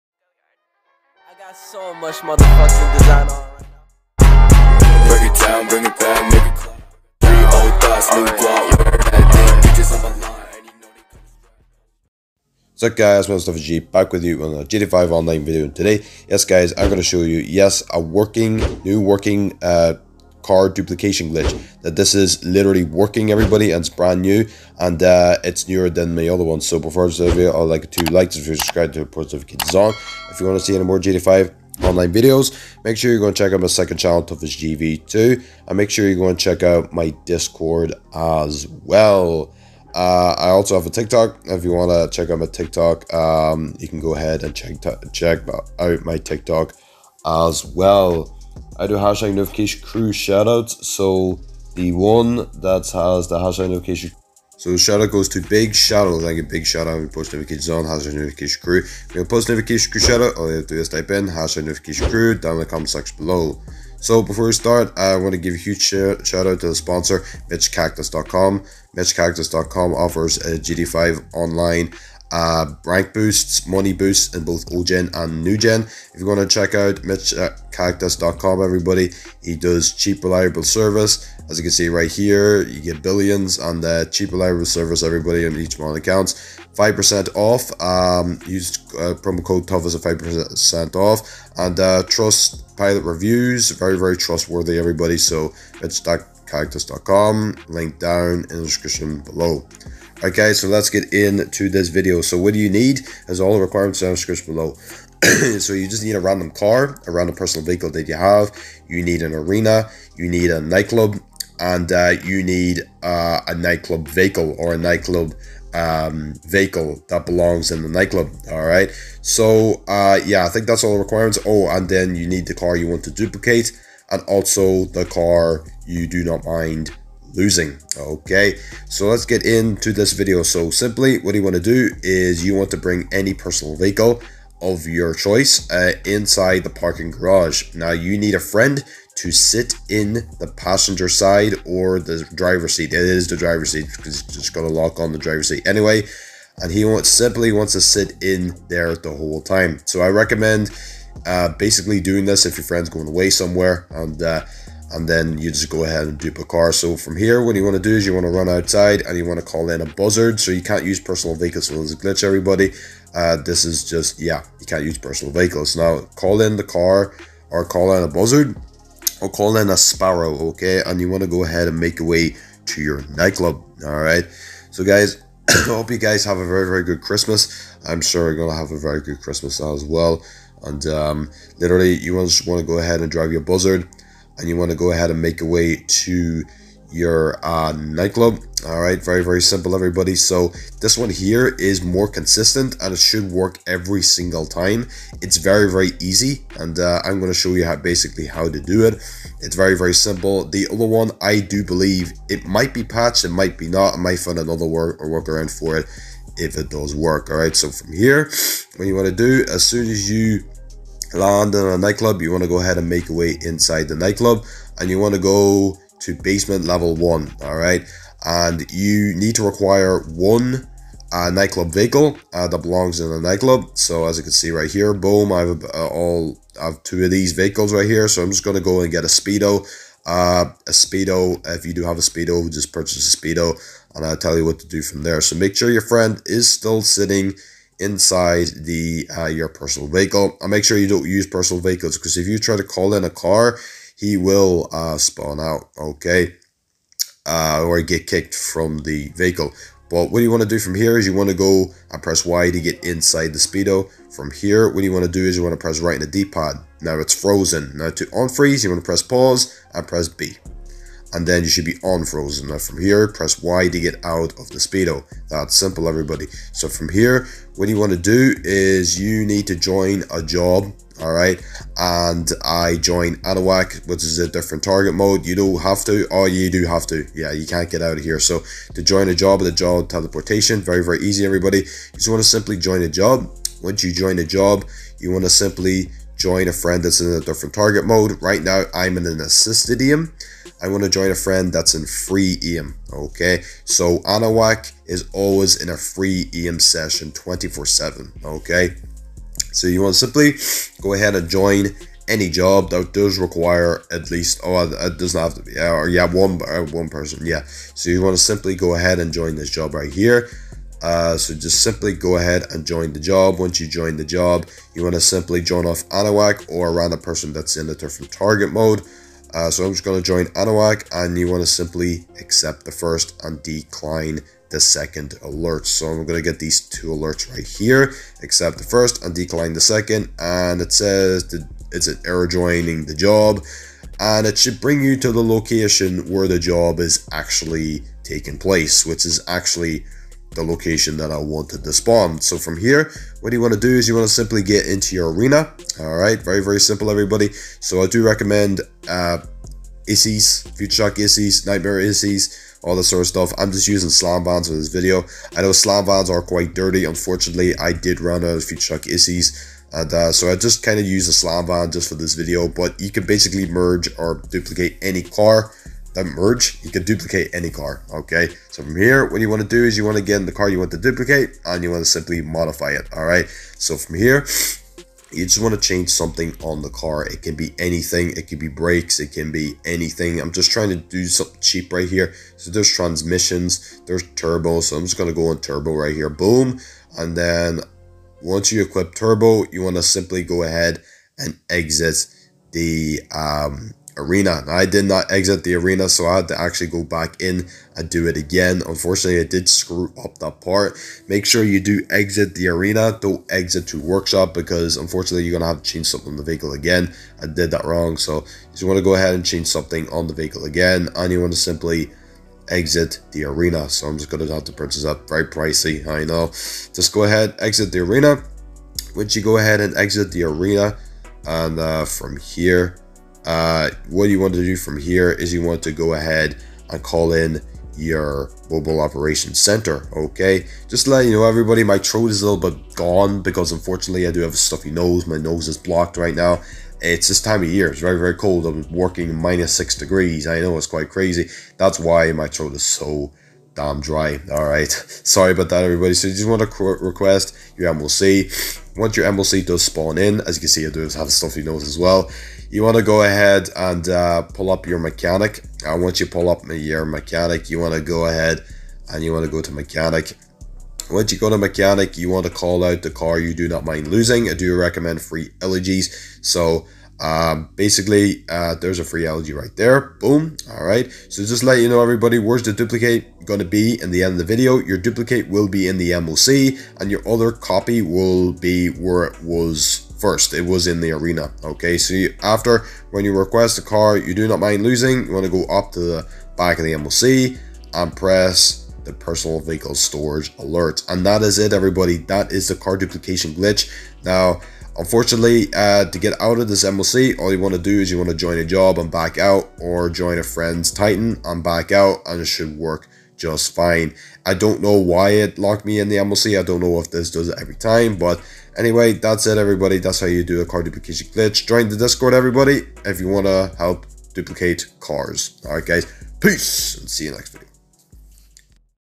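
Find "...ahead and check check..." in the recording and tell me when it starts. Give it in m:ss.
0:44.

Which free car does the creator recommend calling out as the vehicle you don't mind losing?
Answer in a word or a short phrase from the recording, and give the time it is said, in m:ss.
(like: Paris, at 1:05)
Elegy, at 7:45.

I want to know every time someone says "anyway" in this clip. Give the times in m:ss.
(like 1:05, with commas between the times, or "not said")
2:25, 8:28.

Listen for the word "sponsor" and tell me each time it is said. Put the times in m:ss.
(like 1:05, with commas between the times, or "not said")
1:06.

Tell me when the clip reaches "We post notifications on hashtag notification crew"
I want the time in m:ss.
0:57.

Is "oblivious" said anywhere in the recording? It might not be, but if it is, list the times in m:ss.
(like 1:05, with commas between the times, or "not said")
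not said.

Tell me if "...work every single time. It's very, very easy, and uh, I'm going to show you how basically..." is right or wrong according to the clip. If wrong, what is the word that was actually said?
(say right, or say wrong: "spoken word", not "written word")
right.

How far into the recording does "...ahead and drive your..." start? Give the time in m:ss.
3:02.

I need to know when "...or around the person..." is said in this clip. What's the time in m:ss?
5:16.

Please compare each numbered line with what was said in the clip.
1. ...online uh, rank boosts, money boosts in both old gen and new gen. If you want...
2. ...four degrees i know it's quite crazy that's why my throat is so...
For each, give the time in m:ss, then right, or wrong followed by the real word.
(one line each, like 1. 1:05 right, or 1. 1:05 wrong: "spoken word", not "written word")
1. 1:11 right
2. 7:19 wrong: "six", not "four".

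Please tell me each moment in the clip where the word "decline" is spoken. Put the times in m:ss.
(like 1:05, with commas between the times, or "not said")
5:23, 5:29.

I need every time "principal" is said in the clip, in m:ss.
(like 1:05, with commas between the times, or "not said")
not said.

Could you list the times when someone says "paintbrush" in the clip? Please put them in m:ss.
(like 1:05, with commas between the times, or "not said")
not said.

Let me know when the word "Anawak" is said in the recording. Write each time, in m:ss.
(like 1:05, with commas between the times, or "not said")
4:53, 5:15.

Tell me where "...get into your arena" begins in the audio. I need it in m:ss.
5:44.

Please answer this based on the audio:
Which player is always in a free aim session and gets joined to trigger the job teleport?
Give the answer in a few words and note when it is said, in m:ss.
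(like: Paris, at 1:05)
Anahuac, at 4:33.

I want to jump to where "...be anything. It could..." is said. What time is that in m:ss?
6:17.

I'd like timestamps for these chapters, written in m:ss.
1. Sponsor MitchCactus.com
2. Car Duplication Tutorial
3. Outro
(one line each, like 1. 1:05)
1. 1:00
2. 1:40
3. 8:20.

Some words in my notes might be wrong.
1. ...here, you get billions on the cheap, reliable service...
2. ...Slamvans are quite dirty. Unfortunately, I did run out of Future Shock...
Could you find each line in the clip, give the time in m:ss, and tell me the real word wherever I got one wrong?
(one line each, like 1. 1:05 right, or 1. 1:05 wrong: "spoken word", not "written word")
1. 1:22 right
2. 5:55 right.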